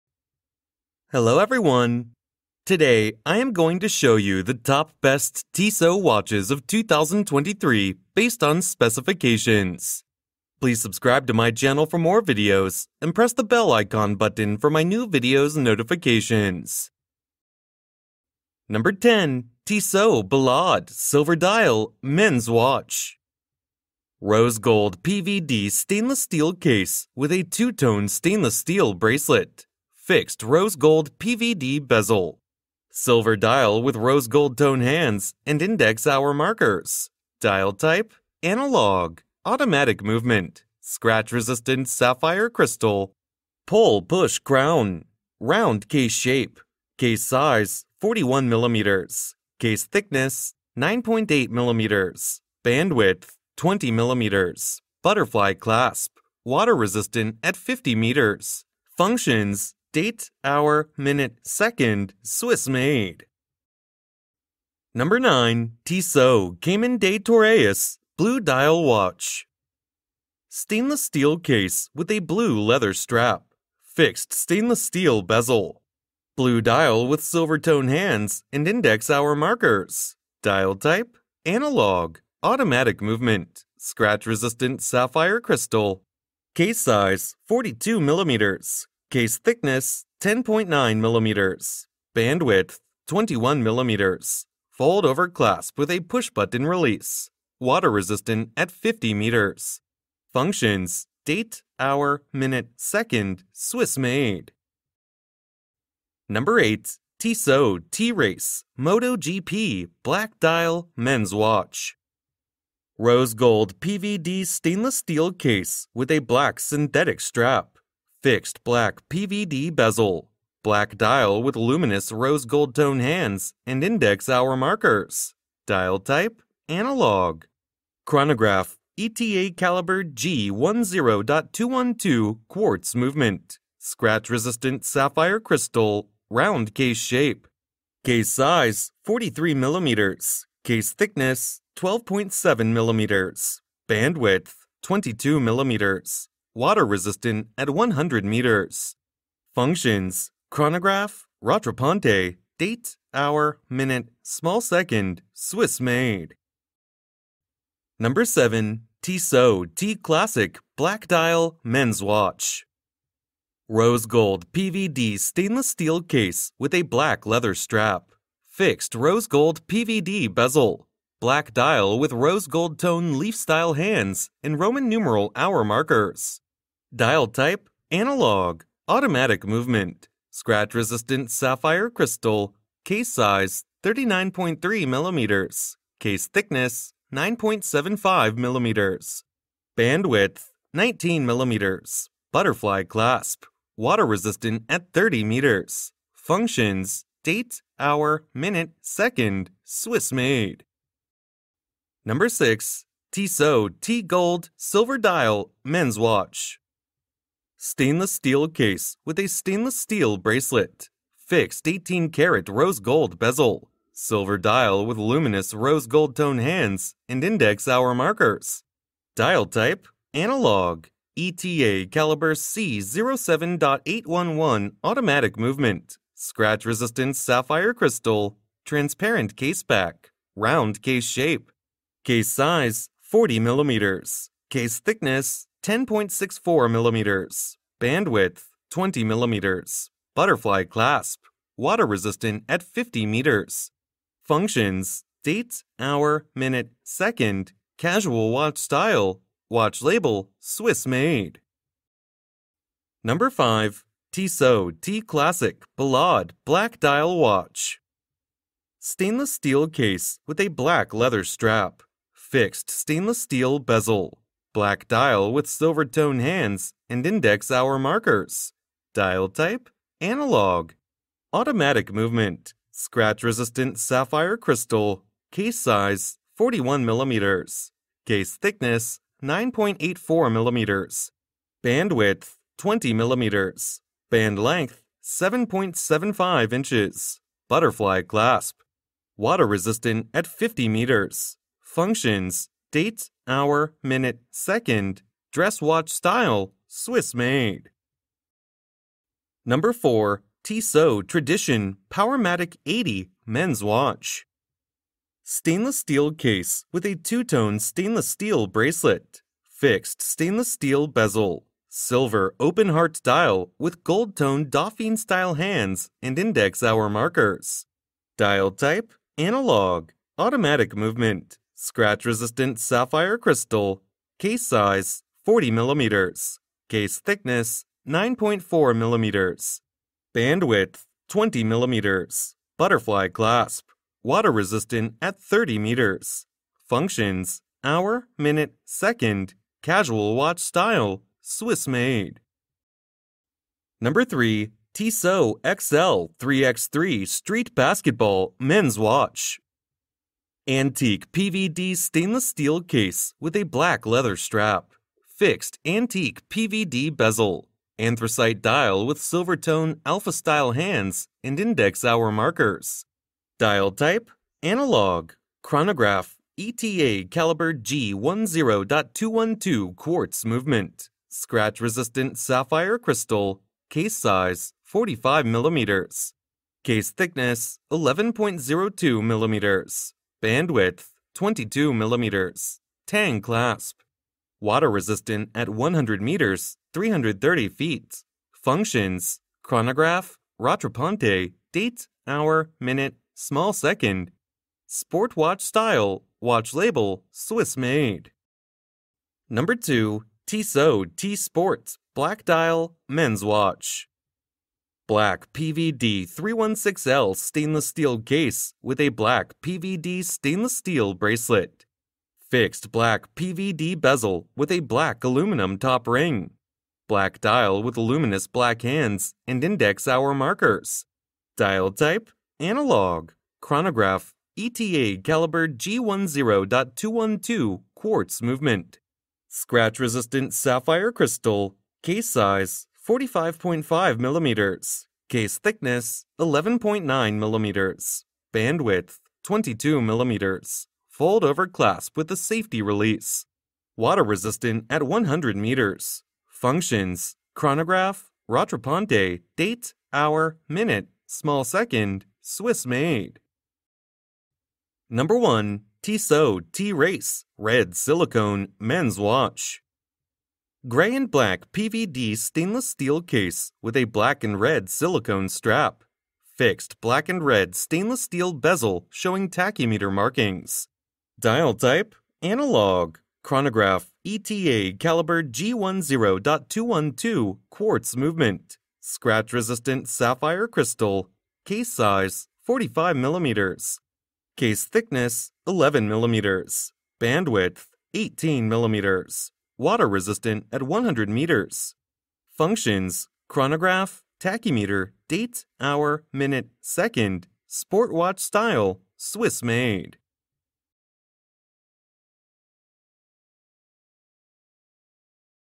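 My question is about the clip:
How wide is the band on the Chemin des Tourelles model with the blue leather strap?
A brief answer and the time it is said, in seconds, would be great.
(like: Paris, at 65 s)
21 millimeters, at 92 s.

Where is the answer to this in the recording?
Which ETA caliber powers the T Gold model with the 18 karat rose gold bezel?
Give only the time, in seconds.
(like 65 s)
221 s.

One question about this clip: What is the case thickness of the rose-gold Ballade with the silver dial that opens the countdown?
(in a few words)
9.8 millimeters.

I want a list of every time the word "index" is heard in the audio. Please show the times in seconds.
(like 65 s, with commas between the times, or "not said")
35 s, 78 s, 123 s, 217 s, 267 s, 316 s, 361 s, 419 s.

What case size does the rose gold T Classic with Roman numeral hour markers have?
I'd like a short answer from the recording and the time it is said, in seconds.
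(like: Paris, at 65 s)
39.3 millimeters, at 182 s.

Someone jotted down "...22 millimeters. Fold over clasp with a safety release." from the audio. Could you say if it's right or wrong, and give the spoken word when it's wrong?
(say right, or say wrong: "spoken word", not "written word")
right.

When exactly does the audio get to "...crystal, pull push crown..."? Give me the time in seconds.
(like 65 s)
42 s.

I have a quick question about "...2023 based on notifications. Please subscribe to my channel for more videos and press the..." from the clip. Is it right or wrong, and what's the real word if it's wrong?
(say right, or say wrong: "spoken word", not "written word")
wrong: "specifications", not "notifications".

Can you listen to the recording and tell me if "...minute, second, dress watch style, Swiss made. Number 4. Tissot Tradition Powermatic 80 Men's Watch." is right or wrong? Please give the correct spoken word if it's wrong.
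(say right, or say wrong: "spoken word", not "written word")
right.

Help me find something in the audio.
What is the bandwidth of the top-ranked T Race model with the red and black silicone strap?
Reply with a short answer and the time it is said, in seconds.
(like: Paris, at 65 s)
18 millimeters, at 487 s.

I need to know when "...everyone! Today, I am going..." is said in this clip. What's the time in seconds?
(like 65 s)
1 s.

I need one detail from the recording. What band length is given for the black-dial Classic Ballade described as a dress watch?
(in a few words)
7.75 inches.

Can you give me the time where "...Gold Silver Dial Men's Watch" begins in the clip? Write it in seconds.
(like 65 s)
204 s.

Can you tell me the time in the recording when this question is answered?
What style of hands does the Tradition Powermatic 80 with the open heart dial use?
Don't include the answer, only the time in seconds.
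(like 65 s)
314 s.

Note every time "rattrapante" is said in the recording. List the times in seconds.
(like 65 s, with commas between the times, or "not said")
151 s, 390 s, 448 s.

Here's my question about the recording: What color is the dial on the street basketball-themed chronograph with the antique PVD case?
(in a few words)
Anthracite.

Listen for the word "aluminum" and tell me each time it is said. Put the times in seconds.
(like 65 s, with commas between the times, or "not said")
415 s.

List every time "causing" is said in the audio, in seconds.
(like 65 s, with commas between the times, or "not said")
not said.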